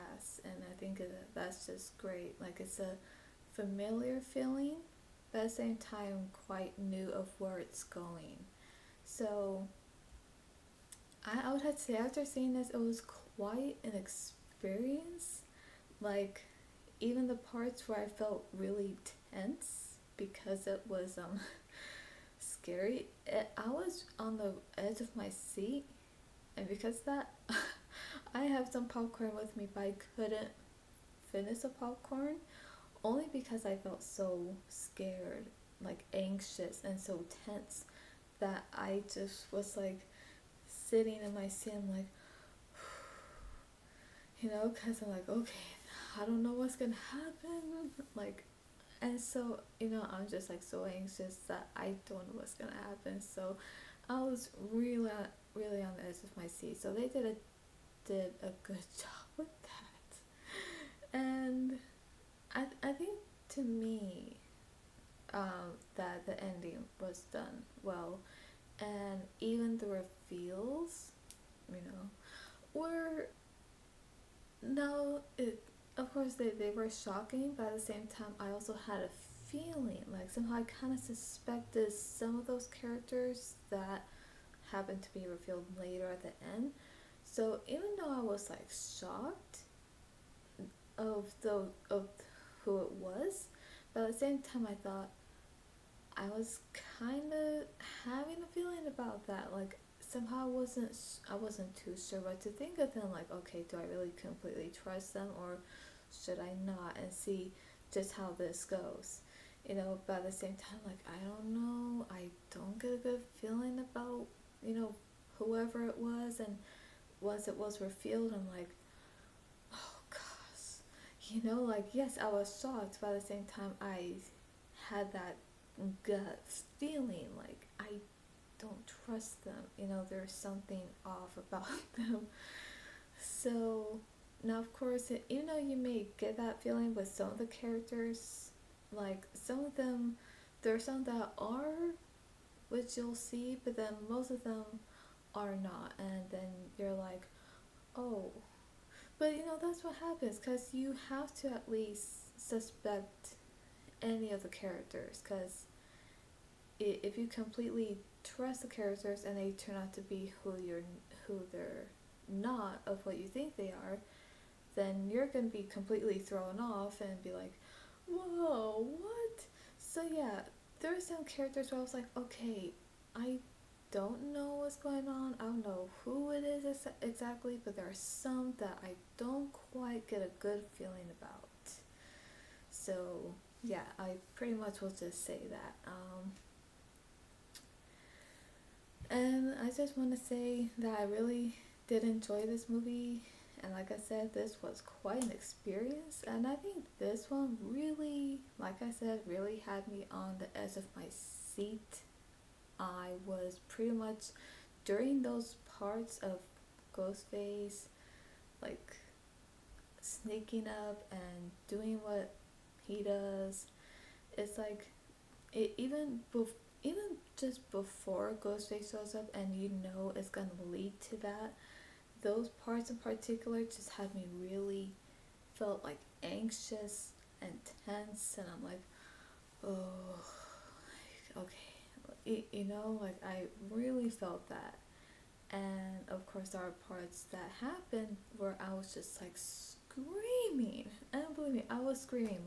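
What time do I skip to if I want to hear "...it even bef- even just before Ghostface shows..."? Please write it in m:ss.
3:35.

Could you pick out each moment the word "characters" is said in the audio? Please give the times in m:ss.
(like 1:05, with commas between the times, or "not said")
1:22, 2:17, 2:34, 2:38, 2:51.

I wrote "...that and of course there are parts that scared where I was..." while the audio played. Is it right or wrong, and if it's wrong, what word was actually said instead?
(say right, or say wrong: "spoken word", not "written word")
wrong: "happened", not "scared".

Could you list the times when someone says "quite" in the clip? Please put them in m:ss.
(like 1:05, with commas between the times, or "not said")
0:06, 0:13, 2:59, 3:15.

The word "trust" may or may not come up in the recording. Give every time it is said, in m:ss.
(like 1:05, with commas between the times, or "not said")
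1:44, 2:09, 2:38.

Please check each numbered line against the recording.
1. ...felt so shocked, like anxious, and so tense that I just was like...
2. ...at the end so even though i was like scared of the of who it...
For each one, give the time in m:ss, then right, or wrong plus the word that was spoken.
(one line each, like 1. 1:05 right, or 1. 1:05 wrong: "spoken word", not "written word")
1. 0:33 wrong: "scared", not "shocked"
2. 1:26 wrong: "shocked", not "scared".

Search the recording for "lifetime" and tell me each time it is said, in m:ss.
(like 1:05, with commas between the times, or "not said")
not said.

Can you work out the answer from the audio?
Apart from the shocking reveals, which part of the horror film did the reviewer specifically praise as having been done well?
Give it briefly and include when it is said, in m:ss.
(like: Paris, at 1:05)
The ending, at 1:06.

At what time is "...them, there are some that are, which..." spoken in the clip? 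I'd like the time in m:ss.
2:19.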